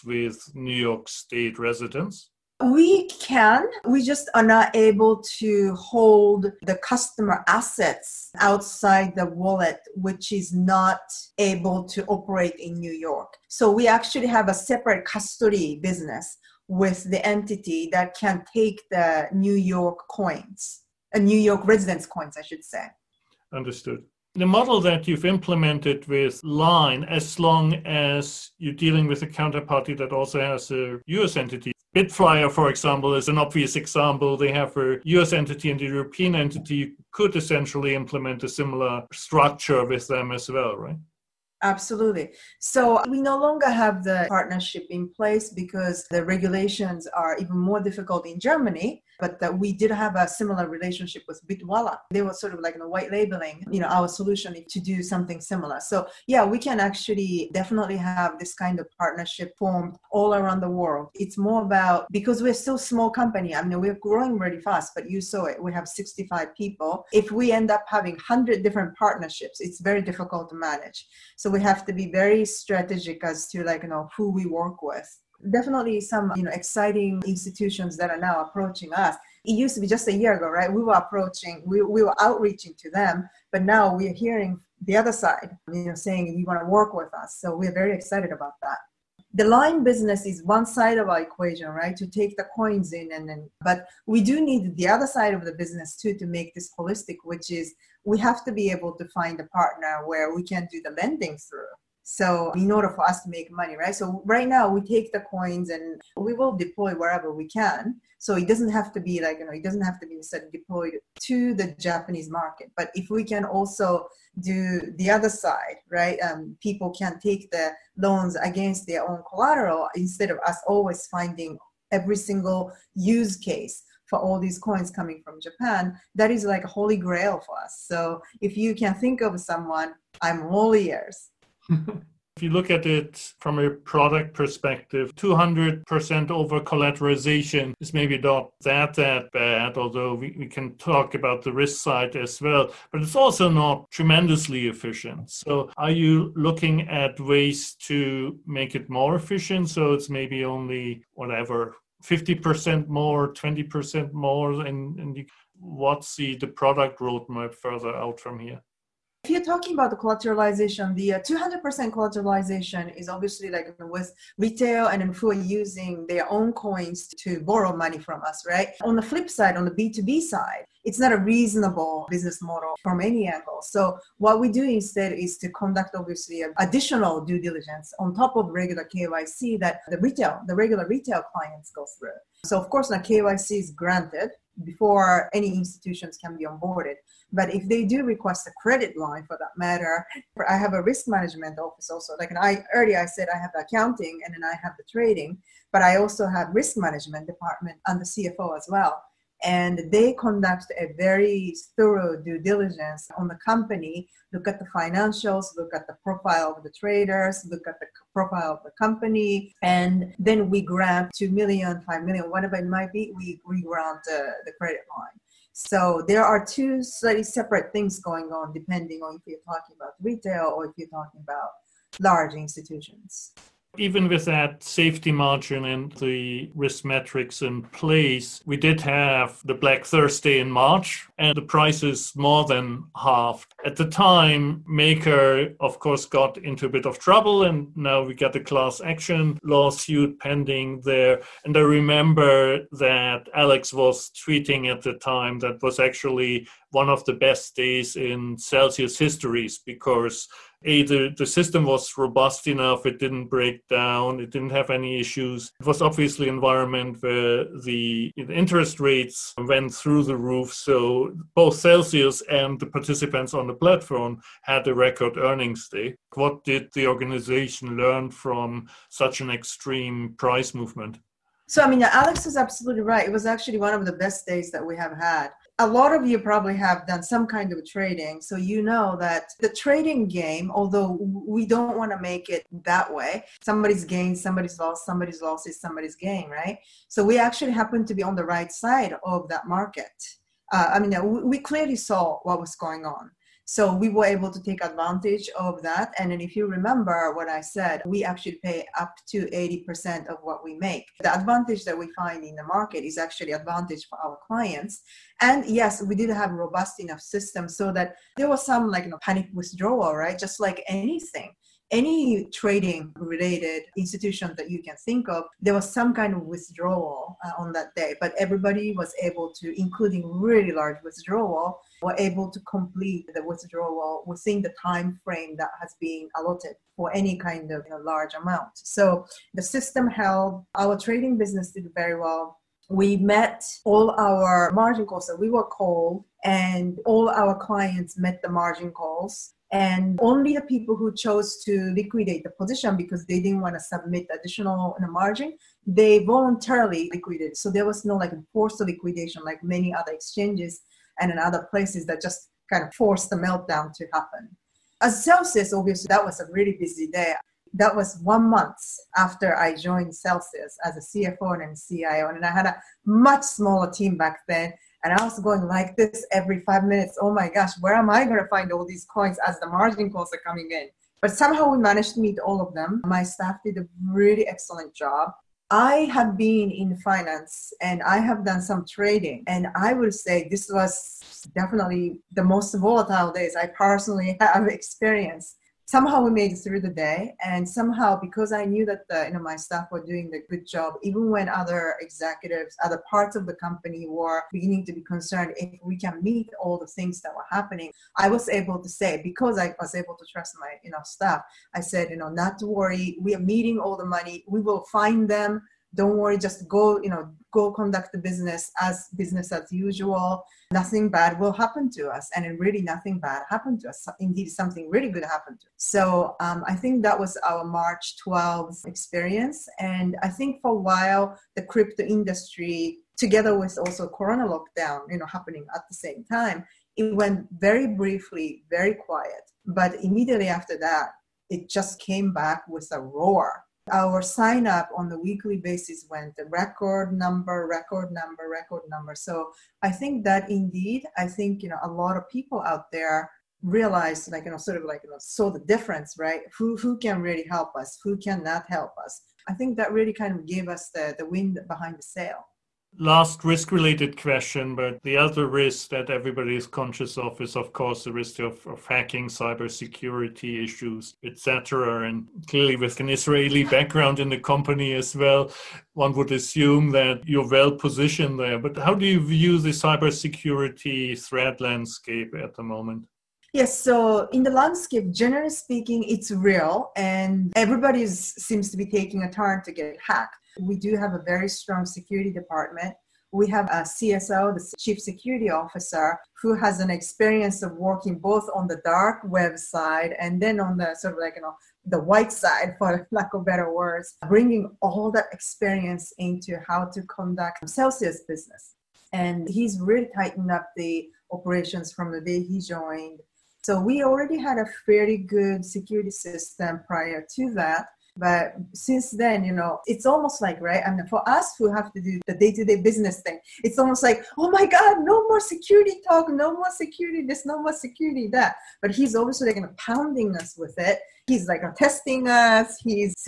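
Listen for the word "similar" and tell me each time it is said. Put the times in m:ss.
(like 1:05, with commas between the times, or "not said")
0:38, 0:50, 0:55.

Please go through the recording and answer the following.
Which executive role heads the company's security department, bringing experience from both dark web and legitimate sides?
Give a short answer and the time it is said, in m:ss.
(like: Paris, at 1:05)
Chief Security Officer, at 8:04.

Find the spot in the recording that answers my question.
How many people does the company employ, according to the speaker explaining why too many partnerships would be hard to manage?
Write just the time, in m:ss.
1:05.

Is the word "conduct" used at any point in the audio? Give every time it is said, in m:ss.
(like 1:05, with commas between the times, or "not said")
2:55, 3:20, 6:47, 8:16.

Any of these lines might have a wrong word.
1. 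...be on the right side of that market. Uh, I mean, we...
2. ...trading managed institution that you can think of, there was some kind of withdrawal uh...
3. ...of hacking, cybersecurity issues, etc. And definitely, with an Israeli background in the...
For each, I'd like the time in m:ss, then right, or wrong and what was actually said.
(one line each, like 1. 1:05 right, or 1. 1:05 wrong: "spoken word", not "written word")
1. 4:47 right
2. 5:12 wrong: "related", not "managed"
3. 7:38 wrong: "clearly", not "definitely".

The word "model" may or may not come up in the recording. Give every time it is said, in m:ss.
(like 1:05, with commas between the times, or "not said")
0:24, 2:52.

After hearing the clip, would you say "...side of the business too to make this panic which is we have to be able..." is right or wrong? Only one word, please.
wrong.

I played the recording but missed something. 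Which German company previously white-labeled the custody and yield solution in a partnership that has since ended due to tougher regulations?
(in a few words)
Bitwala.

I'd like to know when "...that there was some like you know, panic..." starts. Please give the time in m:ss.
5:07.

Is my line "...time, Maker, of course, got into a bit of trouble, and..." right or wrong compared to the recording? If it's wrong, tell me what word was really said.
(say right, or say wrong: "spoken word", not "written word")
right.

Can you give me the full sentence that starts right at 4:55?
And then if you remember what I said, we actually pay up to 80% of what we make.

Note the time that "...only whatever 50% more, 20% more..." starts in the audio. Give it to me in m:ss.
2:30.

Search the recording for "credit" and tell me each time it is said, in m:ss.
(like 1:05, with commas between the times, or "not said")
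3:08, 3:34.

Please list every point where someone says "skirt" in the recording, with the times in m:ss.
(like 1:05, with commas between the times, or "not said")
not said.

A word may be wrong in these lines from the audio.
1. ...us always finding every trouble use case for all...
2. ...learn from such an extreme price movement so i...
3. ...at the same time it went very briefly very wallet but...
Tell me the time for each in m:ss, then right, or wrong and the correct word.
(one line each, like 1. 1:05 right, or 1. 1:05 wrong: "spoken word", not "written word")
1. 2:00 wrong: "single", not "trouble"
2. 4:27 right
3. 7:05 wrong: "quiet", not "wallet".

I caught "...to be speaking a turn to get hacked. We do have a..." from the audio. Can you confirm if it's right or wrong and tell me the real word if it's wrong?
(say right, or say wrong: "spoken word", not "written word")
wrong: "taking", not "speaking".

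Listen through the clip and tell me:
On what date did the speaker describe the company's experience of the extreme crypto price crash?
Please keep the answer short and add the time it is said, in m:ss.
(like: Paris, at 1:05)
March 12th, at 6:57.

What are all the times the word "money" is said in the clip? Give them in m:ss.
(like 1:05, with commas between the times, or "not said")
1:43, 2:47, 6:43.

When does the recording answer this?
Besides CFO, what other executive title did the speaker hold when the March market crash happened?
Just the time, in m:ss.
6:01.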